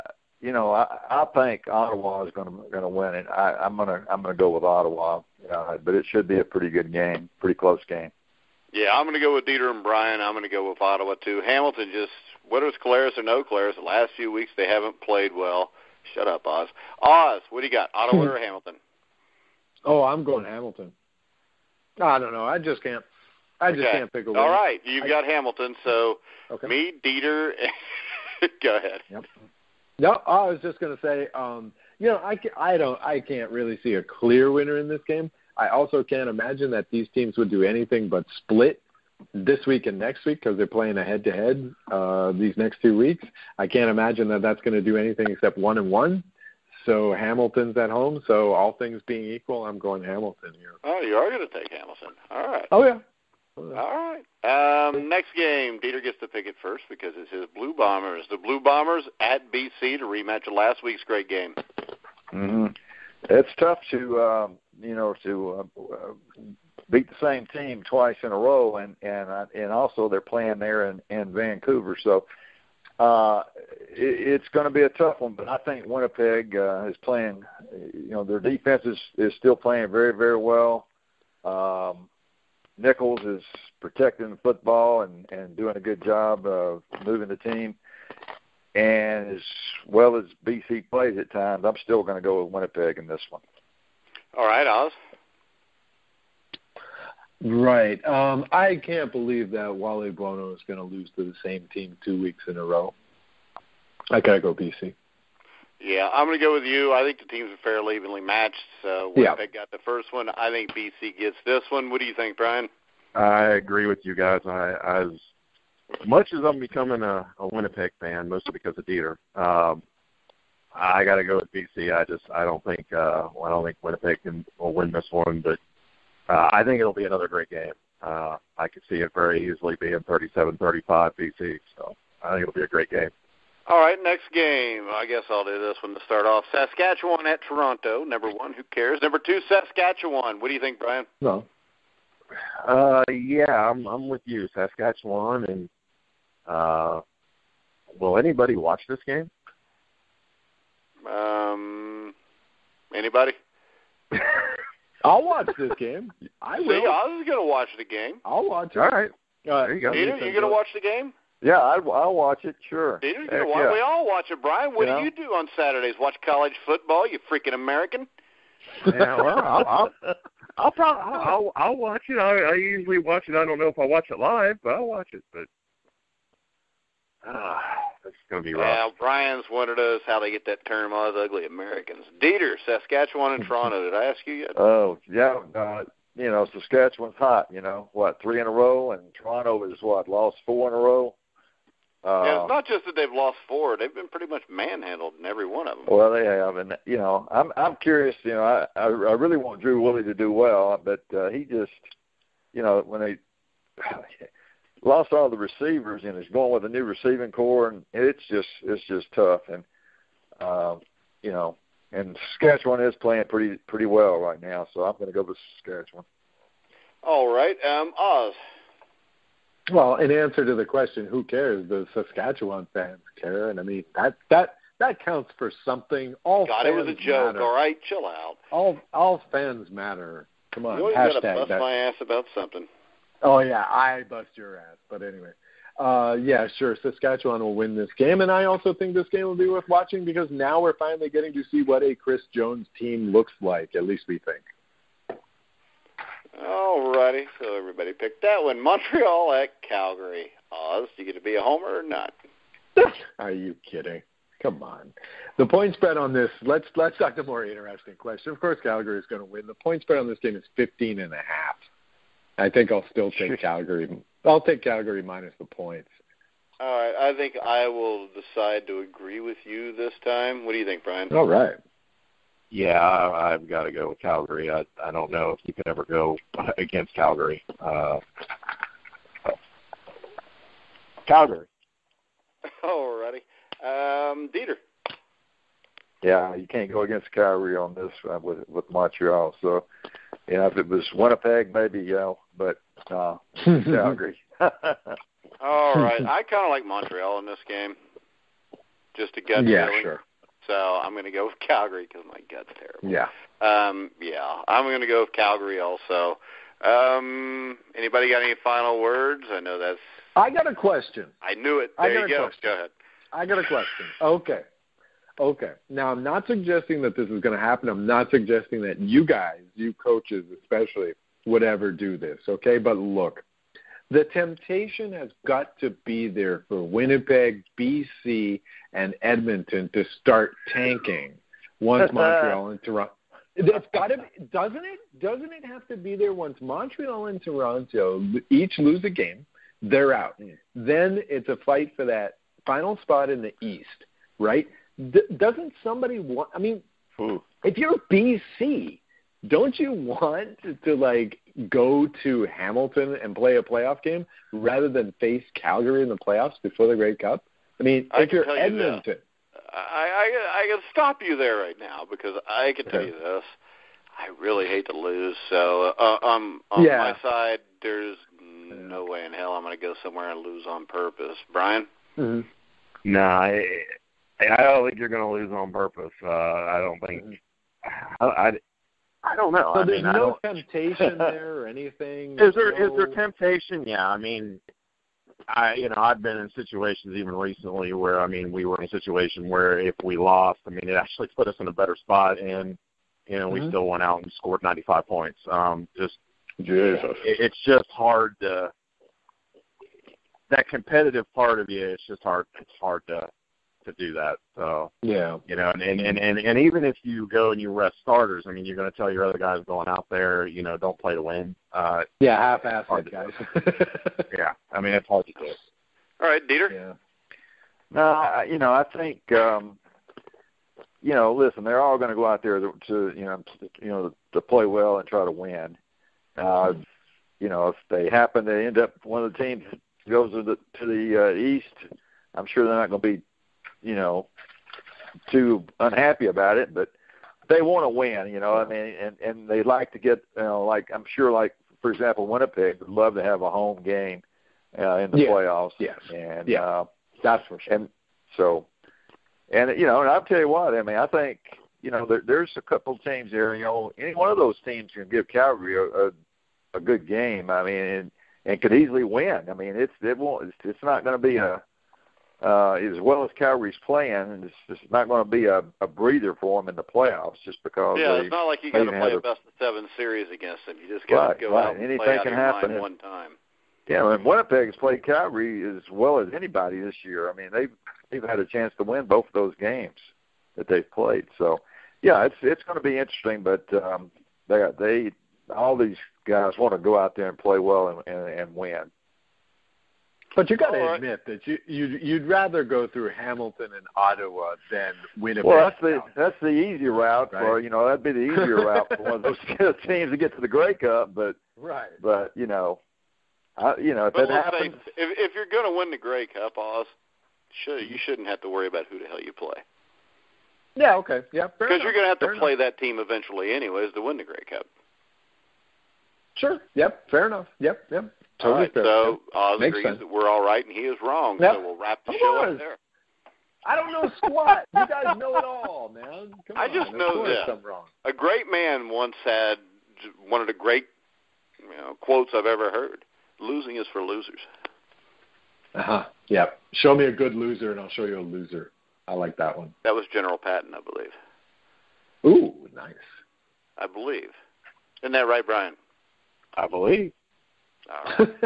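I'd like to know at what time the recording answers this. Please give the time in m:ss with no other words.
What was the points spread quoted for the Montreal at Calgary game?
4:20.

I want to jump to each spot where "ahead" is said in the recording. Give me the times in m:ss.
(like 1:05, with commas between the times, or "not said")
0:28, 5:12.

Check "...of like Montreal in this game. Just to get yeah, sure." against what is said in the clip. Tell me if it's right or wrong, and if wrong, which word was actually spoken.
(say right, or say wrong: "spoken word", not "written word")
right.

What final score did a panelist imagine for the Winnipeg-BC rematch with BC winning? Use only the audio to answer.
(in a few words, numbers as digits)
37-35.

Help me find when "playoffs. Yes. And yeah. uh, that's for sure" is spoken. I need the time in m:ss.
7:25.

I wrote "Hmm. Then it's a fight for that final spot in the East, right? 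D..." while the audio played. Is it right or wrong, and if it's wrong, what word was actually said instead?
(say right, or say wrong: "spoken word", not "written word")
right.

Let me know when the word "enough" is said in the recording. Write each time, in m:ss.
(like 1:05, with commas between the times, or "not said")
8:32, 8:37.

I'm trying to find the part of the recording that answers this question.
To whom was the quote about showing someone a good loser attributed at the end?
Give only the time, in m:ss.
8:59.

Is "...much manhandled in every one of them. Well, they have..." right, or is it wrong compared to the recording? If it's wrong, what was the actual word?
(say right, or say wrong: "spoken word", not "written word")
right.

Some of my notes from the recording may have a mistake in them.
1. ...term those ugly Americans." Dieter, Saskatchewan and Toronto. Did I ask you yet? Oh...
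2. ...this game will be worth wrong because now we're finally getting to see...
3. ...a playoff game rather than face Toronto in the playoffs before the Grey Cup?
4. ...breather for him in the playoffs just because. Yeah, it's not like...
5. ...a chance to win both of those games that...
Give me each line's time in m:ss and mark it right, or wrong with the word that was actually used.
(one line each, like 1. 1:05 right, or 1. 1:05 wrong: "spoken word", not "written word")
1. 3:00 right
2. 3:58 wrong: "watching", not "wrong"
3. 5:53 wrong: "Calgary", not "Toronto"
4. 7:45 right
5. 7:58 right.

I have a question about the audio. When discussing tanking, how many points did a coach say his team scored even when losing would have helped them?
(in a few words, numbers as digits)
95.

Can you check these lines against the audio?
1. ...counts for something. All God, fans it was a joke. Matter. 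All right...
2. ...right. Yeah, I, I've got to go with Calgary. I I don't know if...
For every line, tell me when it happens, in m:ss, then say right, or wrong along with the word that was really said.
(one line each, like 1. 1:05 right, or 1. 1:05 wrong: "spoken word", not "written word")
1. 3:45 right
2. 4:31 right.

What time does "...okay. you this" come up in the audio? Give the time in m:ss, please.
6:02.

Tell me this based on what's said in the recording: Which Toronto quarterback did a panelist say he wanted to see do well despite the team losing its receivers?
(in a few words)
Drew Willy.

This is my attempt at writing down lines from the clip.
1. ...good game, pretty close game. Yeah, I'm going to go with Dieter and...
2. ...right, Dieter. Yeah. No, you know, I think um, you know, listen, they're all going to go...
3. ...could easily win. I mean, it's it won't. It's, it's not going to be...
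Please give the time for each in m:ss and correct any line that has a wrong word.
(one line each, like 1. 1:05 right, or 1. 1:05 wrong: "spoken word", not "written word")
1. 0:06 right
2. 6:56 right
3. 7:38 right.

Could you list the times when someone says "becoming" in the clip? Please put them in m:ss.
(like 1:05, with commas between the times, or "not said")
1:56.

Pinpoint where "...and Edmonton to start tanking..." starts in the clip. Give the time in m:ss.
5:28.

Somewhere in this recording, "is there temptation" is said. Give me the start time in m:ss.
6:22.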